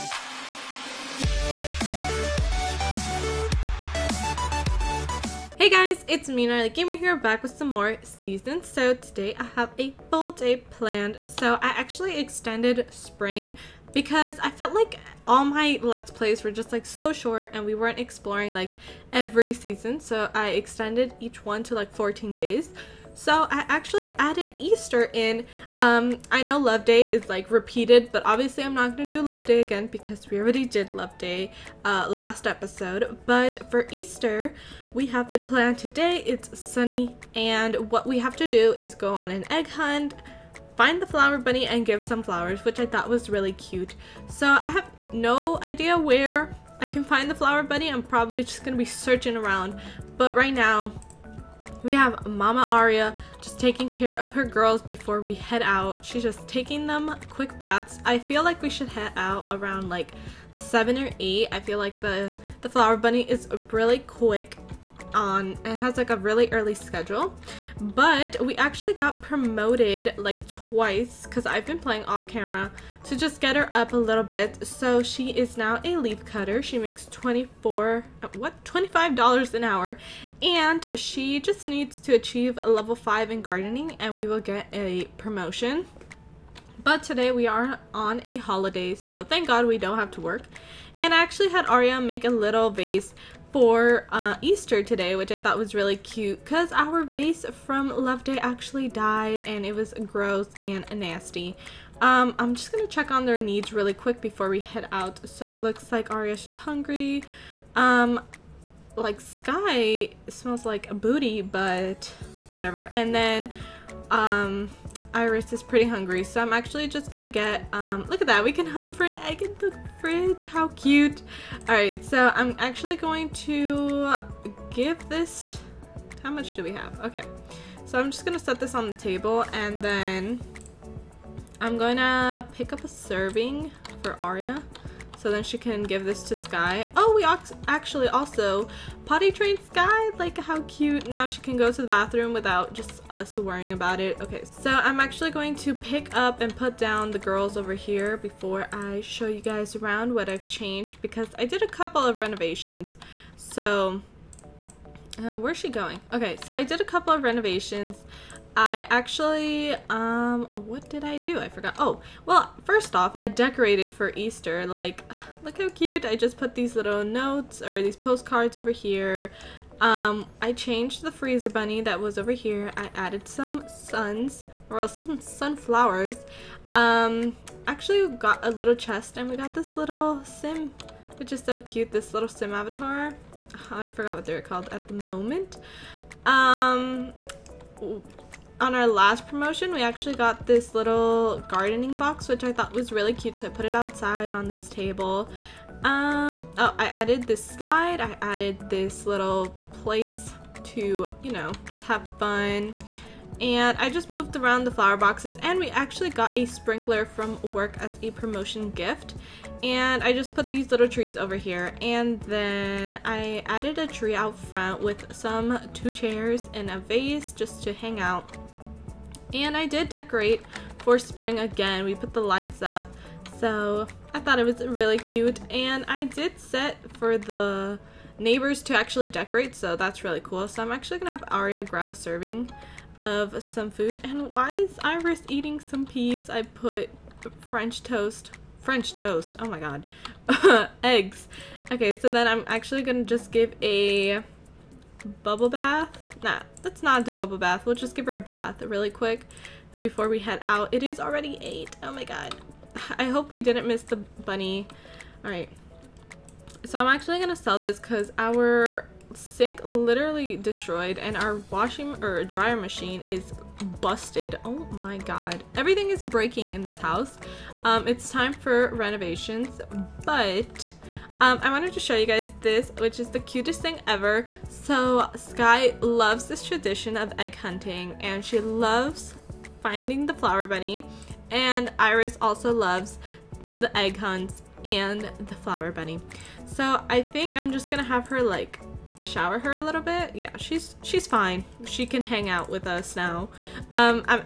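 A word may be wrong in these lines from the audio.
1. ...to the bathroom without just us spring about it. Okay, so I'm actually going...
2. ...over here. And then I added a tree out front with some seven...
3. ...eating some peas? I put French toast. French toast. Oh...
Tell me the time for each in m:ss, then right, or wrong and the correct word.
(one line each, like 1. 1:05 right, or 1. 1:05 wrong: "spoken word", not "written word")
1. 2:21 wrong: "worrying", not "spring"
2. 3:31 wrong: "two", not "seven"
3. 3:55 right.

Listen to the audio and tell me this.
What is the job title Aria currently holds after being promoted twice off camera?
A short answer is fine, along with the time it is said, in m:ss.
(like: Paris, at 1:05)
leaf cutter, at 1:15.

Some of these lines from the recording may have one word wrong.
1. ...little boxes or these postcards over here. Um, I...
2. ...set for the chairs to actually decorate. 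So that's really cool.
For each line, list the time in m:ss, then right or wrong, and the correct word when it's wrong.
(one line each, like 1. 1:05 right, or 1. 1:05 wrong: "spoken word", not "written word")
1. 2:46 wrong: "notes", not "boxes"
2. 3:46 wrong: "neighbors", not "chairs".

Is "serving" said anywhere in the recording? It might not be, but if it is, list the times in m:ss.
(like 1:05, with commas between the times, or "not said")
2:12, 3:51.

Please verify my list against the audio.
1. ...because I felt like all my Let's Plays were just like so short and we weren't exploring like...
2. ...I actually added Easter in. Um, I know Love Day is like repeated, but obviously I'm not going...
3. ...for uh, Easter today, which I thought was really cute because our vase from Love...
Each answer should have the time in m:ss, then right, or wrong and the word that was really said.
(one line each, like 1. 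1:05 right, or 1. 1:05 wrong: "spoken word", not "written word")
1. 0:13 right
2. 0:23 right
3. 1:33 right.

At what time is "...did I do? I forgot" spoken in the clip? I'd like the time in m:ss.
2:40.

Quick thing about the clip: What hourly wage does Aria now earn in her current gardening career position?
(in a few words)
$25.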